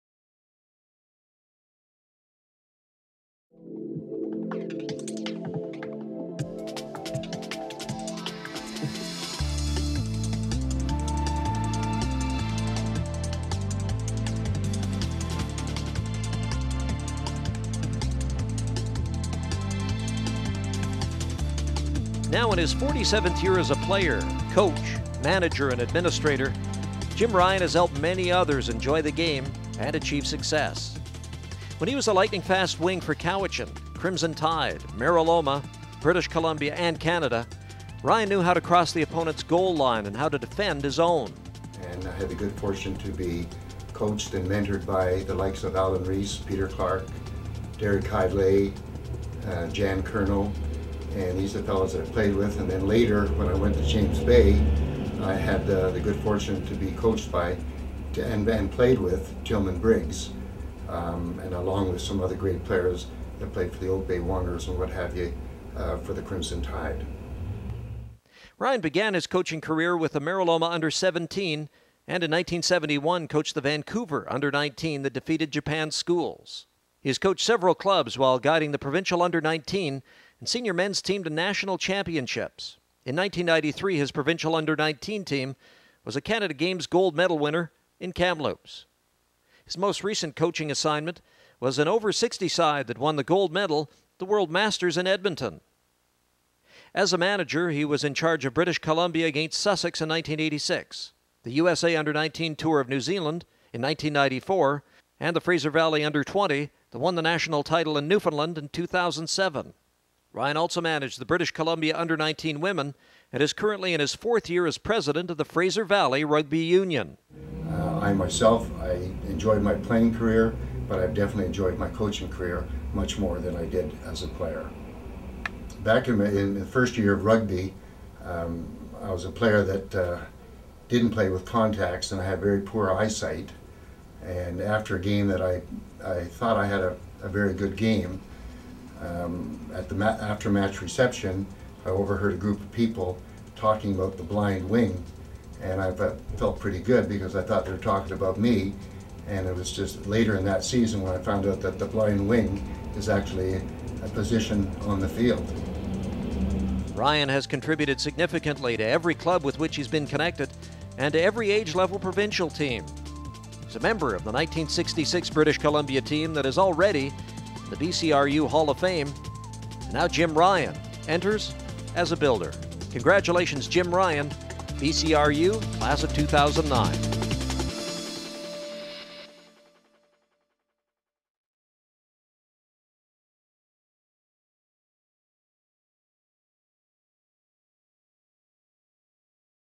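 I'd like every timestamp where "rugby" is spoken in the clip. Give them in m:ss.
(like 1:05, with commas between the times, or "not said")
1:56, 2:07.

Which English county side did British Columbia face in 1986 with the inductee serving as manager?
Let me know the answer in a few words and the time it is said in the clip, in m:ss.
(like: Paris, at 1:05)
Sussex, at 1:39.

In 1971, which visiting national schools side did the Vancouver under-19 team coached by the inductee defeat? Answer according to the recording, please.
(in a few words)
Japan.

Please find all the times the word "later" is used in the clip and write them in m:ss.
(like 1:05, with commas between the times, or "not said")
0:52, 2:30.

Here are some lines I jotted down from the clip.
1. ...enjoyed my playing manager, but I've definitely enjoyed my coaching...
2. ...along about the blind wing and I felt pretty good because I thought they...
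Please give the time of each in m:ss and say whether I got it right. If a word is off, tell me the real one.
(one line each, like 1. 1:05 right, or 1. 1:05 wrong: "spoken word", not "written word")
1. 1:59 wrong: "career", not "manager"
2. 2:23 wrong: "talking", not "along".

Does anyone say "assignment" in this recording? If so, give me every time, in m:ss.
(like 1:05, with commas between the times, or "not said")
1:30.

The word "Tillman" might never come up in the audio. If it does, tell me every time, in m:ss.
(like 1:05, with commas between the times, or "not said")
0:59.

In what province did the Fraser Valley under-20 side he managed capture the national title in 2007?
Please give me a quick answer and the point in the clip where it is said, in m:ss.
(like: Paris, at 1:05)
Newfoundland, at 1:48.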